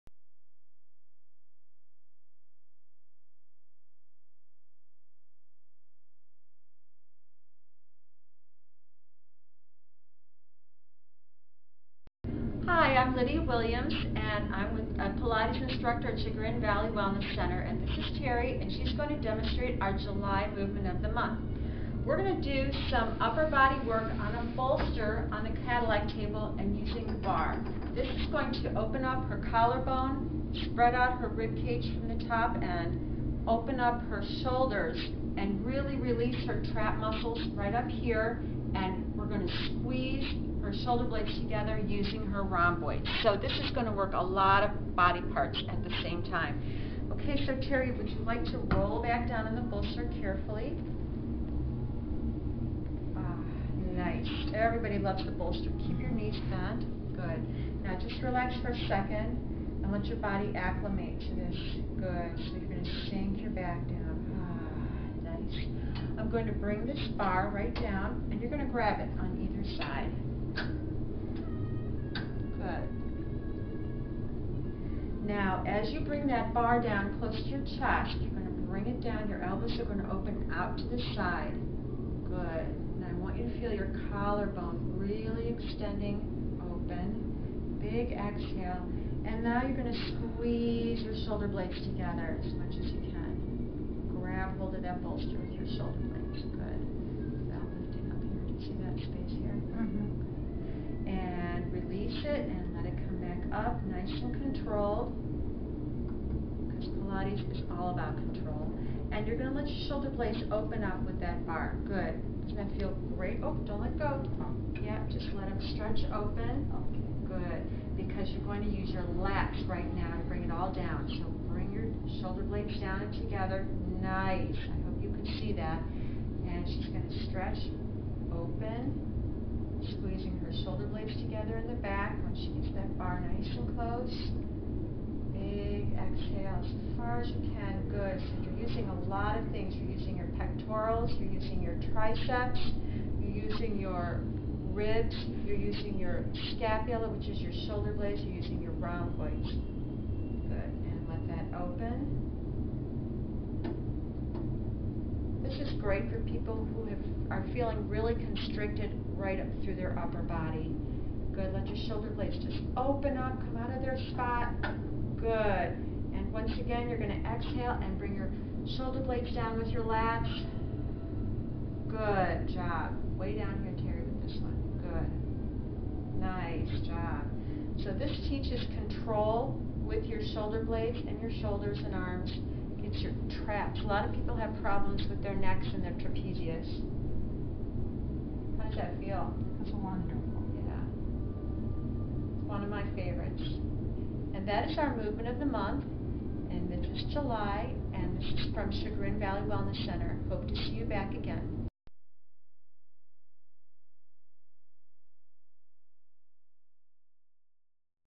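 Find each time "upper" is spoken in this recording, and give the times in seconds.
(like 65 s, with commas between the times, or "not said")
23 s, 159 s.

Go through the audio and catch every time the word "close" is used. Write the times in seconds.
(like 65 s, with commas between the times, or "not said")
77 s, 133 s.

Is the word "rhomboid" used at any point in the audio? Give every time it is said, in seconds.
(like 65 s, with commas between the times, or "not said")
42 s, 148 s.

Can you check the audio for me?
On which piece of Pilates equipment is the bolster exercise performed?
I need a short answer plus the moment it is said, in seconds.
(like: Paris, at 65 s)
Cadillac table, at 25 s.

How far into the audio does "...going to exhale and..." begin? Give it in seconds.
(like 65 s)
166 s.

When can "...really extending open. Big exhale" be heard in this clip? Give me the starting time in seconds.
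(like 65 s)
84 s.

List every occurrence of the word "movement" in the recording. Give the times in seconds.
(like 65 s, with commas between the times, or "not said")
20 s, 194 s.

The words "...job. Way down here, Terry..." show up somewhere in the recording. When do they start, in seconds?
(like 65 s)
172 s.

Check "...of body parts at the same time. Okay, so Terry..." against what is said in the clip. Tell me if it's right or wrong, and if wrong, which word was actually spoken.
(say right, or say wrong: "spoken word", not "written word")
right.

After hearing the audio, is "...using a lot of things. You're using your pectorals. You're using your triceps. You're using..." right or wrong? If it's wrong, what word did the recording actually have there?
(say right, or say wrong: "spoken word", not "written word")
right.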